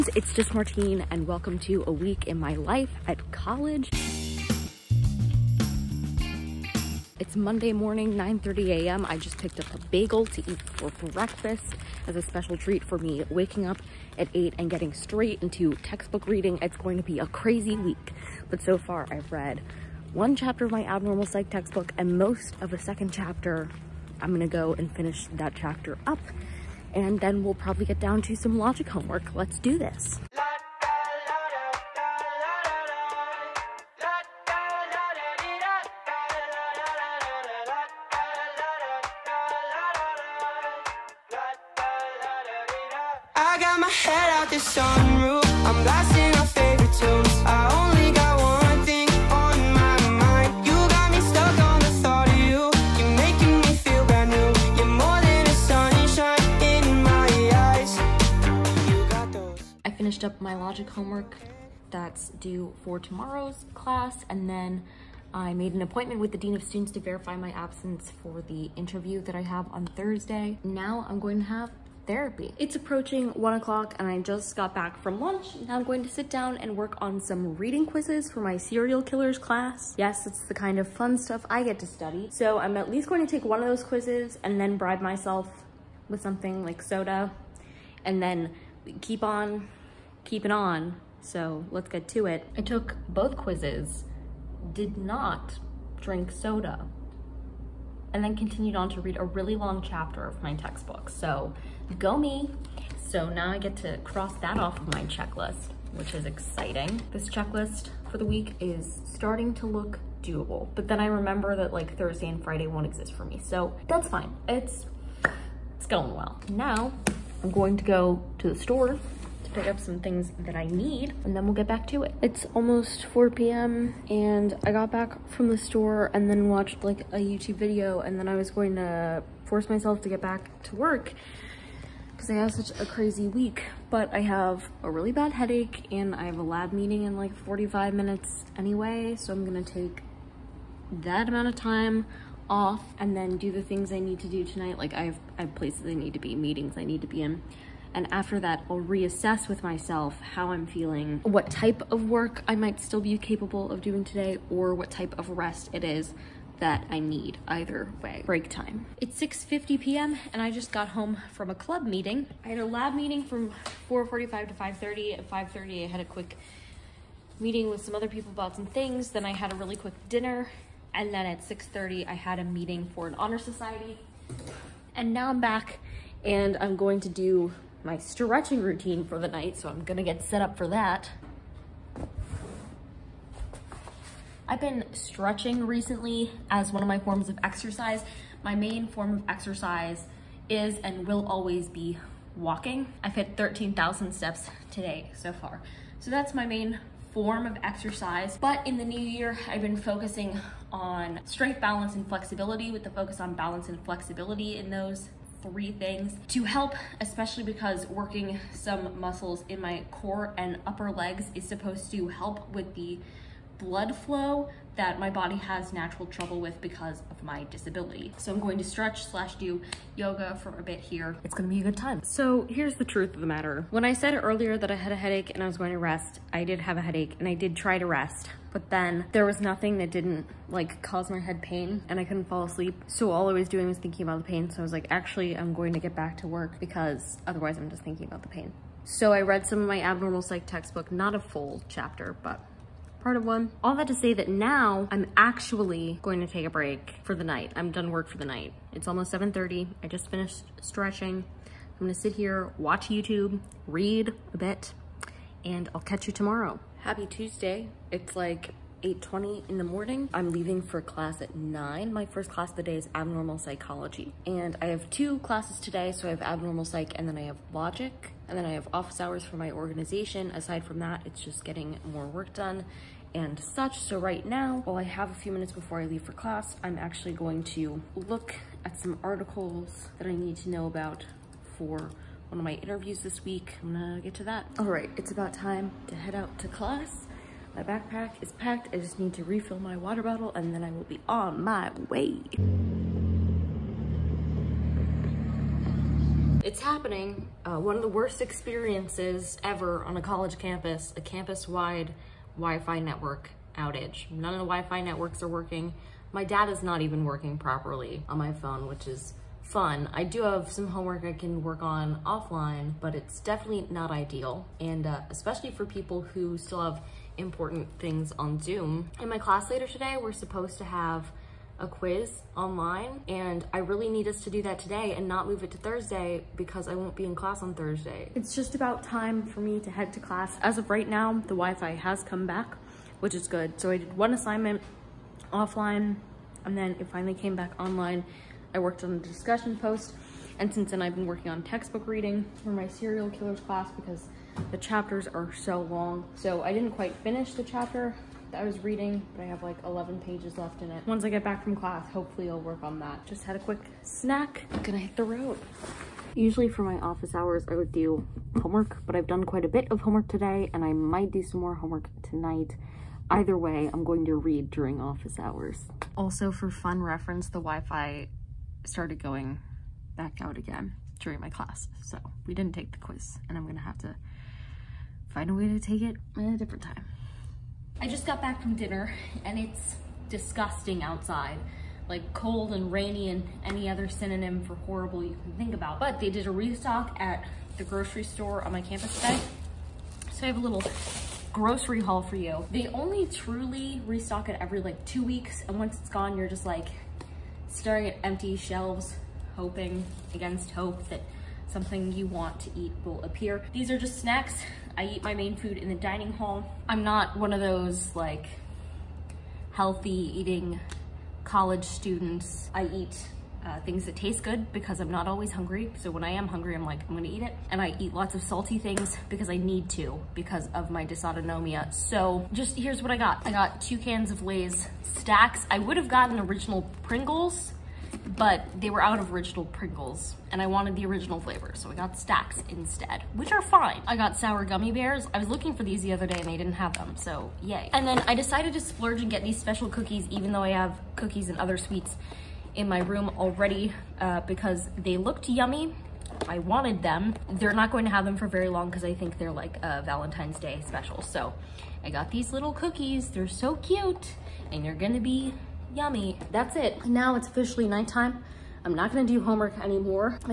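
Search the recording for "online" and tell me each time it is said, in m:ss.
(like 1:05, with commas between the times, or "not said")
5:22, 5:37.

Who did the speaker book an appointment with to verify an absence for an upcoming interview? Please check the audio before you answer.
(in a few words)
Dean of Students.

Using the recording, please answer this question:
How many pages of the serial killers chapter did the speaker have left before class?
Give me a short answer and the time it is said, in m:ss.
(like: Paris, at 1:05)
11, at 5:49.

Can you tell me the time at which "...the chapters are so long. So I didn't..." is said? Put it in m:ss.
5:44.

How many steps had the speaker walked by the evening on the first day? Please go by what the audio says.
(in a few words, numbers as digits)
13,000.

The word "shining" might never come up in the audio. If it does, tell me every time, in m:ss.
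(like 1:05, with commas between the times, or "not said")
not said.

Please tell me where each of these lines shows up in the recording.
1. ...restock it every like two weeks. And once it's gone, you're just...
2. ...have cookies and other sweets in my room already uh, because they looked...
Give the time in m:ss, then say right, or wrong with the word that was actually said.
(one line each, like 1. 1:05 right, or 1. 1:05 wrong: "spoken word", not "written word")
1. 6:33 right
2. 7:20 right.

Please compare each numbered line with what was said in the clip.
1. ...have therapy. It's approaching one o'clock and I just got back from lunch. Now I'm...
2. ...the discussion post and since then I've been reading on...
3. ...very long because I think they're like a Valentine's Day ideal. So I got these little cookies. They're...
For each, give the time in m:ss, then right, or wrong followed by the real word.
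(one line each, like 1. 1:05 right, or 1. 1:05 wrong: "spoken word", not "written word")
1. 1:11 right
2. 5:38 wrong: "working", not "reading"
3. 7:28 wrong: "special", not "ideal".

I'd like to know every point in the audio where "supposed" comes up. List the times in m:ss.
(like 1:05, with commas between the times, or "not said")
3:31, 5:20.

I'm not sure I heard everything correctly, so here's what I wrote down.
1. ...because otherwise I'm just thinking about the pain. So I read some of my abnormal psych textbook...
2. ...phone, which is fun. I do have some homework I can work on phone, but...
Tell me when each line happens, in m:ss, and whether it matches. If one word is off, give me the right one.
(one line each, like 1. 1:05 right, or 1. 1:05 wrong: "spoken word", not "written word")
1. 3:56 right
2. 5:08 wrong: "offline", not "phone".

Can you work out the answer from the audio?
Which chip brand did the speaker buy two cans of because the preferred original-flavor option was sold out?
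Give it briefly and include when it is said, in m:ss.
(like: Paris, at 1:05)
Lay's Stax, at 7:04.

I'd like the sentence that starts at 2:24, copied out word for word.
Like I have, I have places I need to be, meetings I need to be in.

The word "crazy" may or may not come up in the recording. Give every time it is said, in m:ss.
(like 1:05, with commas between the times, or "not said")
0:17, 2:12.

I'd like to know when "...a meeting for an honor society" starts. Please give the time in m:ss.
2:52.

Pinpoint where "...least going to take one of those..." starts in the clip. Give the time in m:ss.
1:22.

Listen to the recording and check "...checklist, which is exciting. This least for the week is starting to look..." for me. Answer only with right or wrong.
wrong.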